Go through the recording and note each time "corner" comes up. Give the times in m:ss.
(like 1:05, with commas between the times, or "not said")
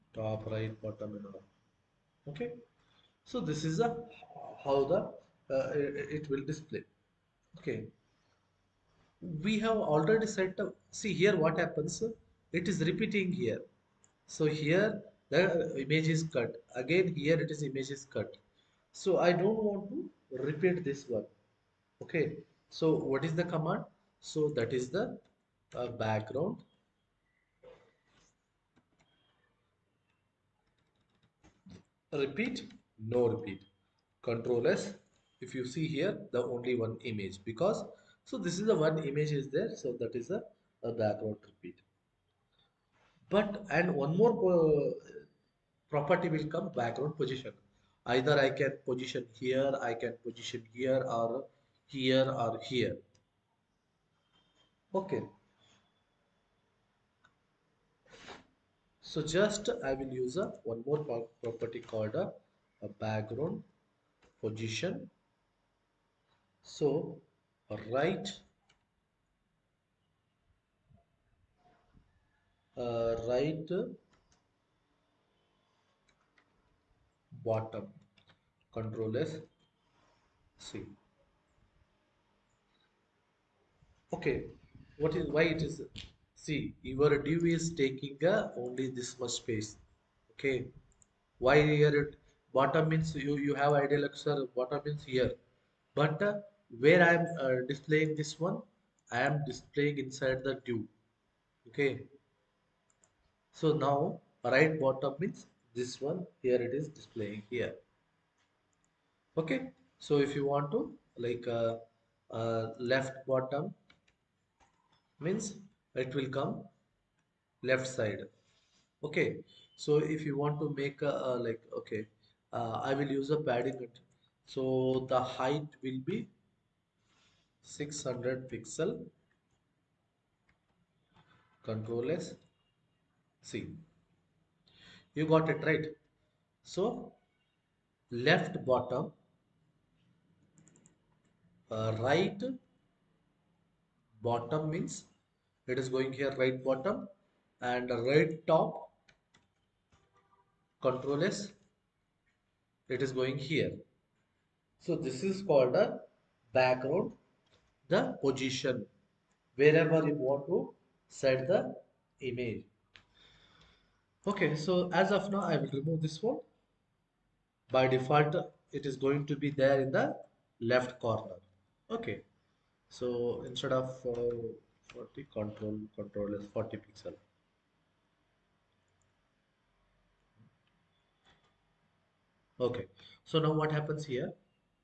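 2:51.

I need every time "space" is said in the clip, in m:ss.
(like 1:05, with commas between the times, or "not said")
1:29.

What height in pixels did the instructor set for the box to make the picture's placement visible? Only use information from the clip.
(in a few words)
600 pixels.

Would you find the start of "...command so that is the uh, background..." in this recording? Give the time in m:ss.
0:23.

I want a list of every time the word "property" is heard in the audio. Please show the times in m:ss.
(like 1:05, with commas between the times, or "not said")
0:45, 1:01.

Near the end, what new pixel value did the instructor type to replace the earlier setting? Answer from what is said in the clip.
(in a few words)
40 pixels.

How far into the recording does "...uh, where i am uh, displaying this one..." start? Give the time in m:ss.
1:36.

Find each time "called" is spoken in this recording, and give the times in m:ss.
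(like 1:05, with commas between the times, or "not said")
1:01, 2:35.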